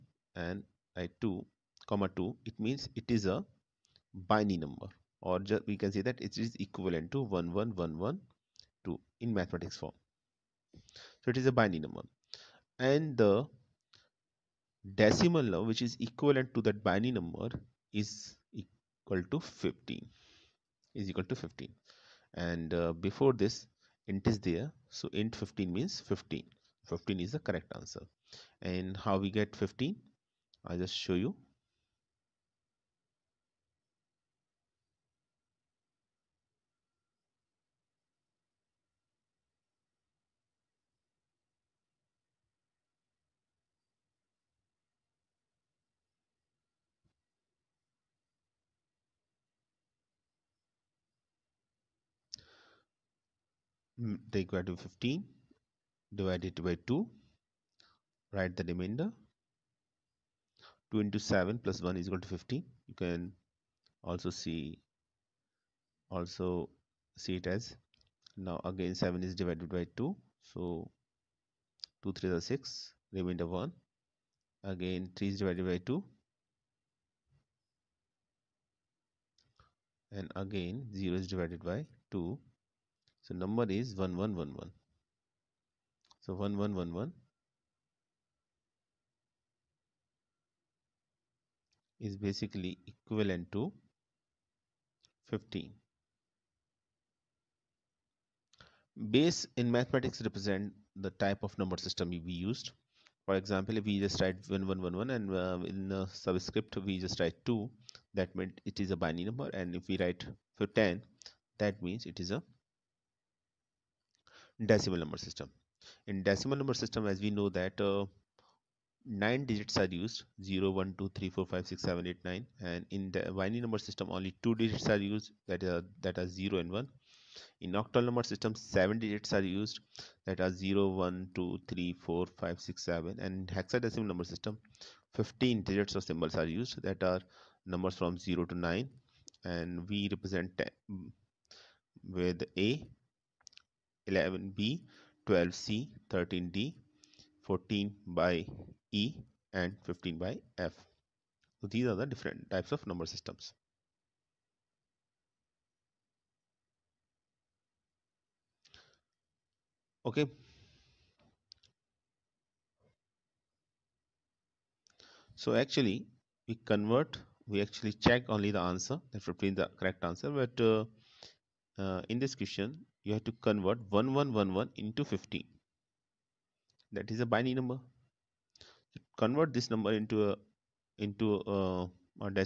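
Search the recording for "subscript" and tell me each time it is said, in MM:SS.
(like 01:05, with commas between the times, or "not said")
01:46.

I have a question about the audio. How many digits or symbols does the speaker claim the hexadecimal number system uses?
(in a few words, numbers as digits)
15.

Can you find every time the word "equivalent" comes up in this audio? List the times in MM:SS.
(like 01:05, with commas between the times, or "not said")
00:06, 00:16, 01:32.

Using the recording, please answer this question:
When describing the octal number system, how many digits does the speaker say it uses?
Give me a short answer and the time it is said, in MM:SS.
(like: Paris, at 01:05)
7, at 02:08.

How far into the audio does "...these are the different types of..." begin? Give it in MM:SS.
02:31.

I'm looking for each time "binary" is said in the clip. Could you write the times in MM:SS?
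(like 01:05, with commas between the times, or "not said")
00:04, 00:11, 00:16, 01:48, 02:03, 02:57.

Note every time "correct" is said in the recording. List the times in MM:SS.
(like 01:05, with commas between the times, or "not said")
00:27, 02:49.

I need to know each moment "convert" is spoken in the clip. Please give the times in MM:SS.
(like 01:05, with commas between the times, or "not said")
02:46, 02:53, 02:59.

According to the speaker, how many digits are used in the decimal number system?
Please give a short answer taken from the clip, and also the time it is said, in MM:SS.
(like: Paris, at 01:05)
9, at 01:59.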